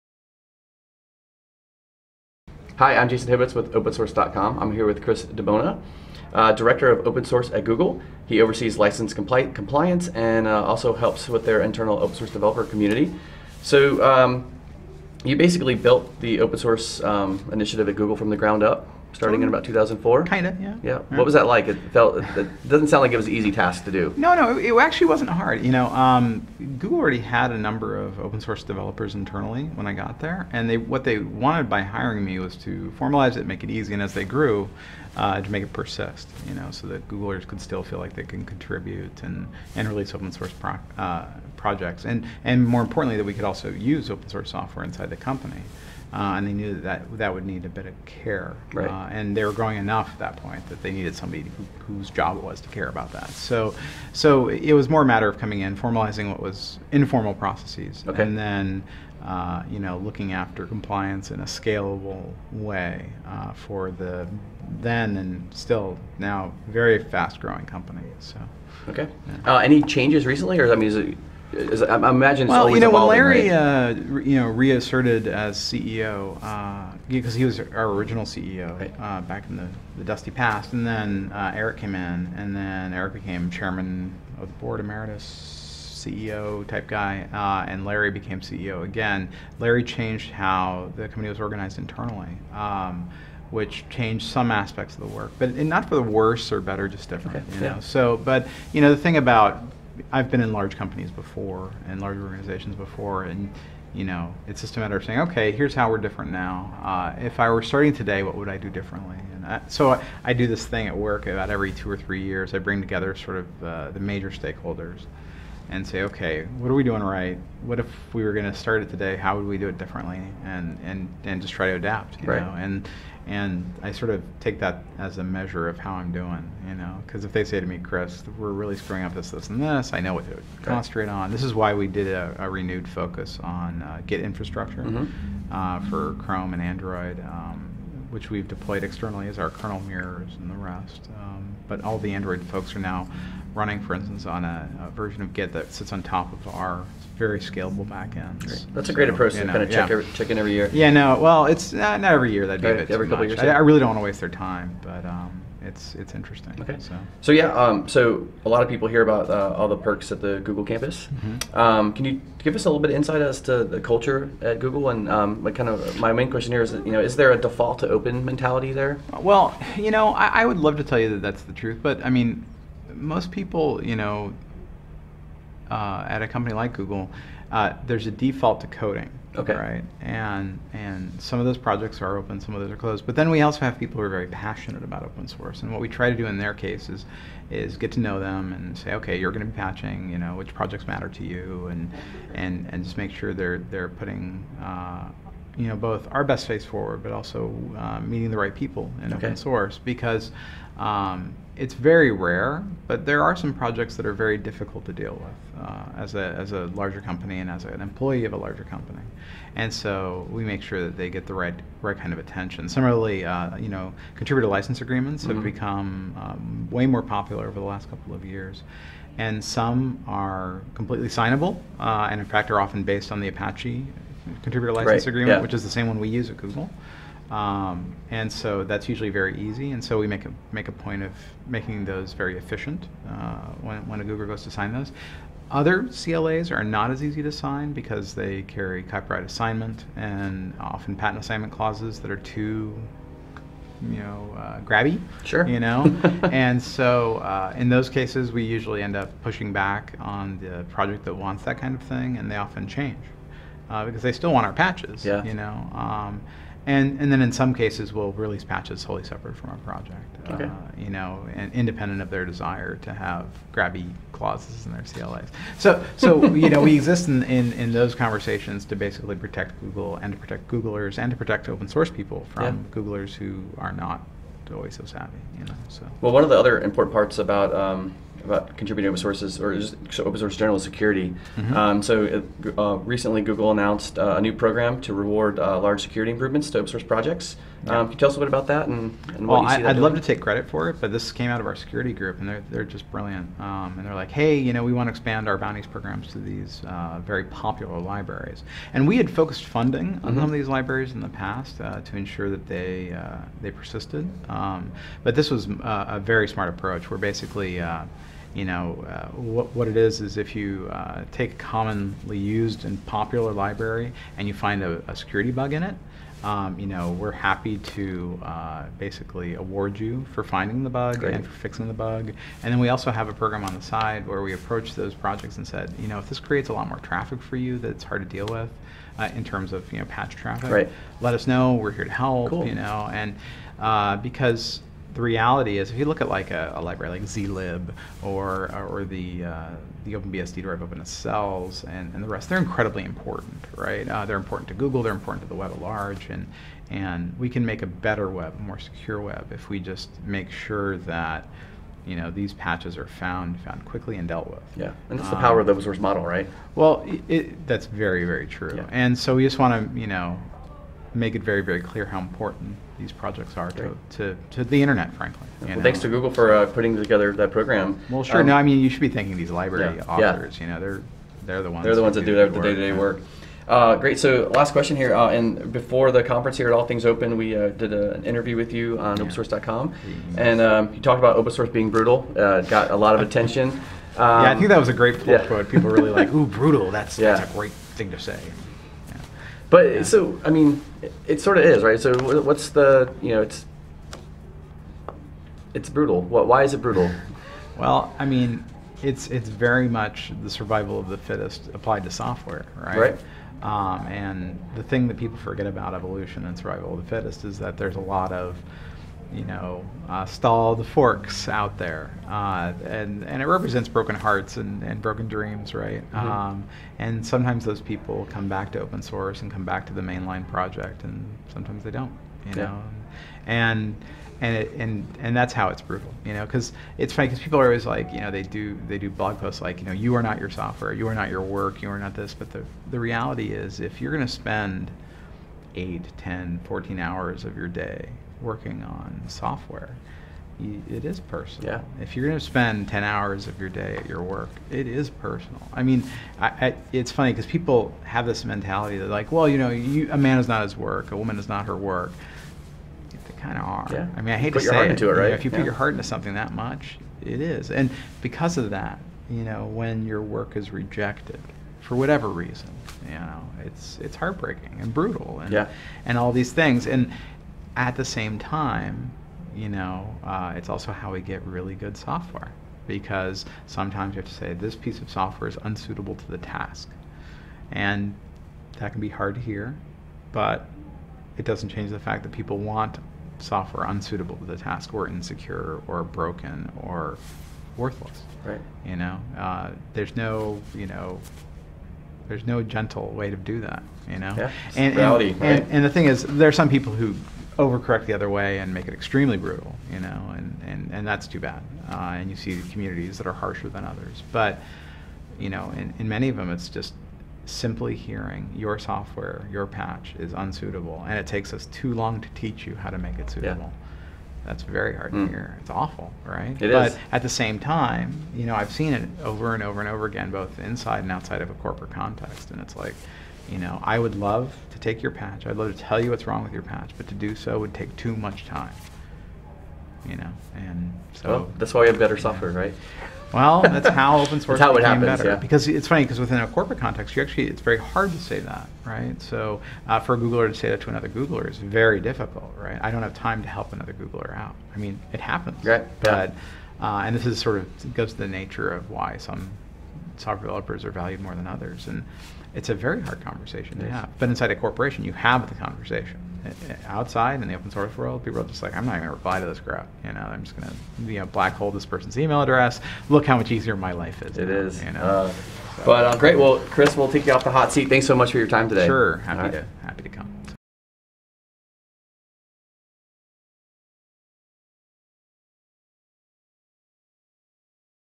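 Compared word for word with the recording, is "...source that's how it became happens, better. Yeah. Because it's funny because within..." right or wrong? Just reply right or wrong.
right.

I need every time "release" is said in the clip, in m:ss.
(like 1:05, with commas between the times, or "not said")
0:39, 4:18.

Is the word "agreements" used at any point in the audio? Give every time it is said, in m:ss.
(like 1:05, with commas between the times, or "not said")
3:34, 3:45.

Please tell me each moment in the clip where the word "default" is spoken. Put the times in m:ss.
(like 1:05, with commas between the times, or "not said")
2:47, 2:58.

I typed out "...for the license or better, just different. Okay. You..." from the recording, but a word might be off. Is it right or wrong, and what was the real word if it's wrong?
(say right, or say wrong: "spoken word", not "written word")
wrong: "worse", not "license".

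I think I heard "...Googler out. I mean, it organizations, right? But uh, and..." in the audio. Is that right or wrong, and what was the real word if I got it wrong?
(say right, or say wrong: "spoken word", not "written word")
wrong: "happens", not "organizations".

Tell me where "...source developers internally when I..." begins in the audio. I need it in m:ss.
0:28.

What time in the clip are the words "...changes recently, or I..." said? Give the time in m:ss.
1:09.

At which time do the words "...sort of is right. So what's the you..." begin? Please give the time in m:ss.
6:31.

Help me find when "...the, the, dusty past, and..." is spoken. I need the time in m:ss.
1:19.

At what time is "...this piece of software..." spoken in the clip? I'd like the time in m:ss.
7:54.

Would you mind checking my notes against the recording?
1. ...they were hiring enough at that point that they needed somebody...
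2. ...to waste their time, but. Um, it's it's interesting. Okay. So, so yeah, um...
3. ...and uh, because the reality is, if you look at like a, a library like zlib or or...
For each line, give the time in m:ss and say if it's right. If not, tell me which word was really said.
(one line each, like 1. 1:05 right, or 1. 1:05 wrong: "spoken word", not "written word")
1. 0:49 wrong: "growing", not "hiring"
2. 2:33 right
3. 5:32 right.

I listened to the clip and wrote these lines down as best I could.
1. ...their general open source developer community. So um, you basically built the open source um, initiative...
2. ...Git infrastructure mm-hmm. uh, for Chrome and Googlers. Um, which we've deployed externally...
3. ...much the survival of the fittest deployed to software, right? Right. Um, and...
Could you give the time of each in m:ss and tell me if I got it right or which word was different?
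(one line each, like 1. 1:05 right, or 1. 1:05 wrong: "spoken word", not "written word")
1. 0:11 wrong: "internal", not "general"
2. 2:14 wrong: "Android", not "Googlers"
3. 6:39 wrong: "applied", not "deployed".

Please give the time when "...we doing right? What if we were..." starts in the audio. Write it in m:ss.
1:56.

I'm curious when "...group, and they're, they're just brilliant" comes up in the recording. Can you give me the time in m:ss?
4:51.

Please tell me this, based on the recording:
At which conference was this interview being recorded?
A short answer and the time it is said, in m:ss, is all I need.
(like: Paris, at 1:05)
All Things Open, at 6:16.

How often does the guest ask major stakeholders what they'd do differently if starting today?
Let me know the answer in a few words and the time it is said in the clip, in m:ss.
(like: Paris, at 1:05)
every two or three years, at 1:51.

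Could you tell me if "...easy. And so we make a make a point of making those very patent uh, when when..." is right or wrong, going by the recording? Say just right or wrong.
wrong.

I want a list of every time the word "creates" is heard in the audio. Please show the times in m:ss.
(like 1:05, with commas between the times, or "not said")
5:26.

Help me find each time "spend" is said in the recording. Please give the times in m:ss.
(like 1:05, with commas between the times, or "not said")
7:14, 7:22.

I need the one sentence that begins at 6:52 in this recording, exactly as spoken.
Uh, and, and it represents broken hearts and, and broken dreams, right?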